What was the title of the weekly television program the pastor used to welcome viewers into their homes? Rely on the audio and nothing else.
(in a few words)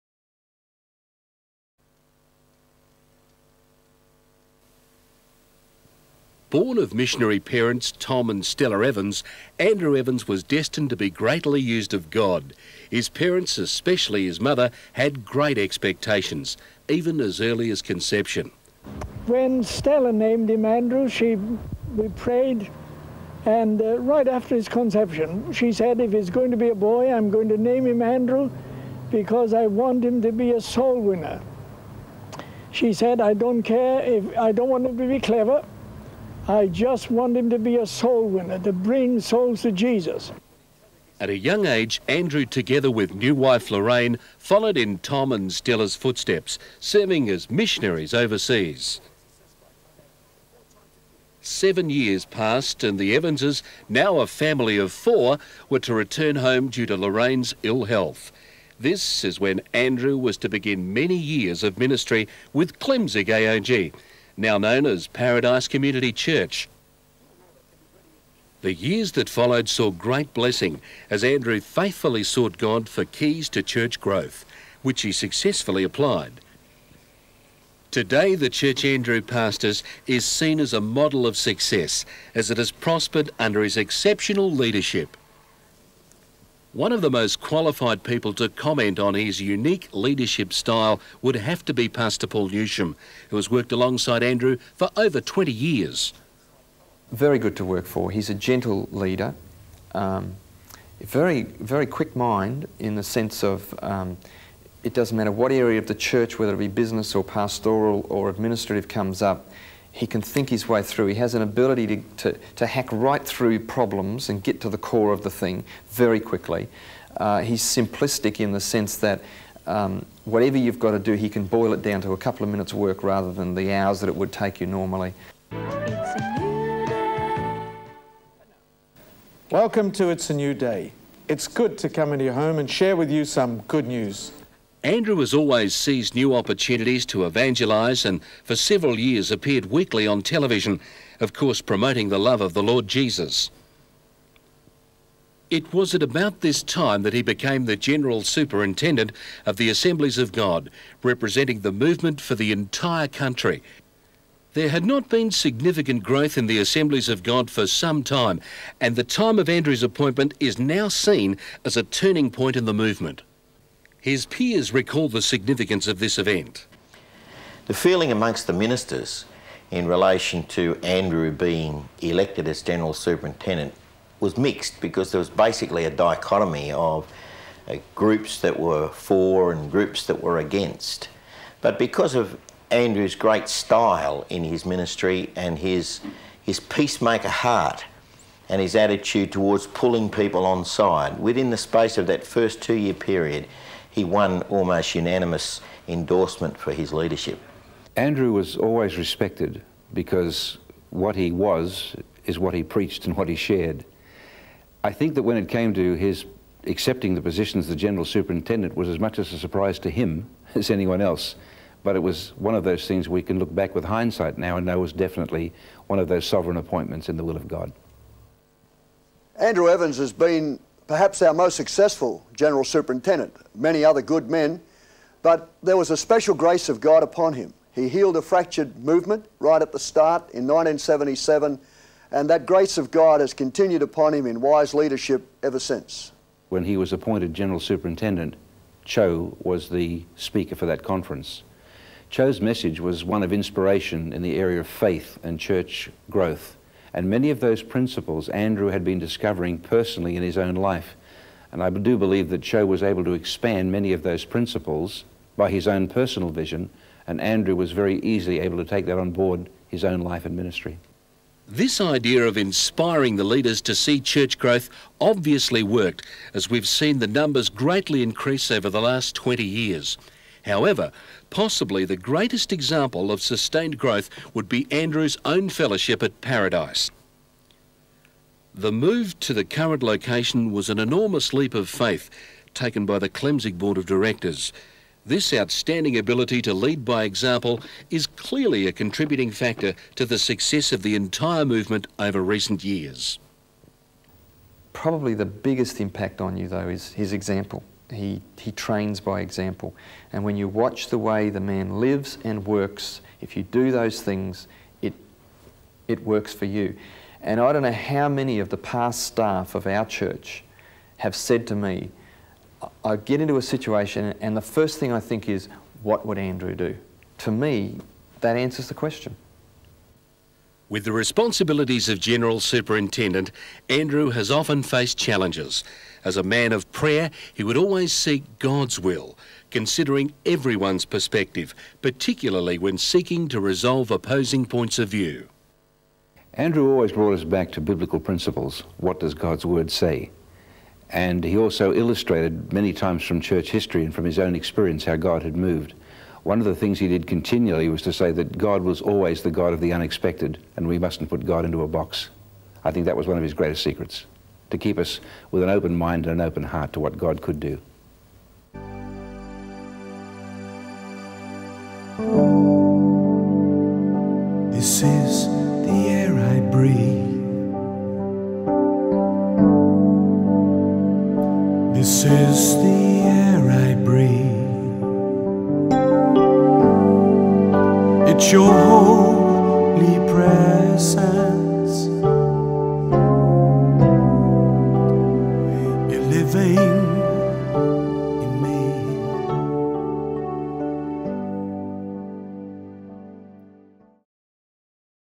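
It's a New Day.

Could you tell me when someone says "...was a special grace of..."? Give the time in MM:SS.
03:45.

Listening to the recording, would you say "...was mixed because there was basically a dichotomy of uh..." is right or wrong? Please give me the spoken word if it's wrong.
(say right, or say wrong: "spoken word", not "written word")
right.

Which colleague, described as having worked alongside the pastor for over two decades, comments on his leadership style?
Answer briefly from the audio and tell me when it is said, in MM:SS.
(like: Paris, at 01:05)
Paul Newsham, at 01:32.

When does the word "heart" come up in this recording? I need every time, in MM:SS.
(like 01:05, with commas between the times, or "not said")
03:07, 05:56.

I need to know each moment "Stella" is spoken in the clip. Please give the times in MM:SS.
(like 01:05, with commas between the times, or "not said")
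00:08, 00:19, 00:45.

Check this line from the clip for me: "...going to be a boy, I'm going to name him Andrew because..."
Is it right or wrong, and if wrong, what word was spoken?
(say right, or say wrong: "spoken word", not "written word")
right.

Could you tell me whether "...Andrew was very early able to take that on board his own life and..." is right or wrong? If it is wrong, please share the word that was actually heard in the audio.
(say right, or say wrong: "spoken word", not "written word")
wrong: "easily", not "early".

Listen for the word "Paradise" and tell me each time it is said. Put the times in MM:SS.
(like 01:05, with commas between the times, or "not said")
01:05, 04:36.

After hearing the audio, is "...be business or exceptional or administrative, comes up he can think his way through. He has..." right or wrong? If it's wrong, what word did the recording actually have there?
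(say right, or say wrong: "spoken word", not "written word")
wrong: "pastoral", not "exceptional".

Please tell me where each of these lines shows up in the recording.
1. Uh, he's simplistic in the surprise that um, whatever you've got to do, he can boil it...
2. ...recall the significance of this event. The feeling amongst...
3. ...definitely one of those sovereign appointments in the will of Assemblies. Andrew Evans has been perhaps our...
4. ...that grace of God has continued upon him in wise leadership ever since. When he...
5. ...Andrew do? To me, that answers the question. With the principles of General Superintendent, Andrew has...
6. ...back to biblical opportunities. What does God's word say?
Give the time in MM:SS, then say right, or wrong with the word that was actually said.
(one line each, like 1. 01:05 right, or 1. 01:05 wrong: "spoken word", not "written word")
1. 01:57 wrong: "sense", not "surprise"
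2. 02:44 right
3. 03:34 wrong: "God", not "Assemblies"
4. 03:52 right
5. 05:16 wrong: "responsibilities", not "principles"
6. 05:37 wrong: "principles", not "opportunities".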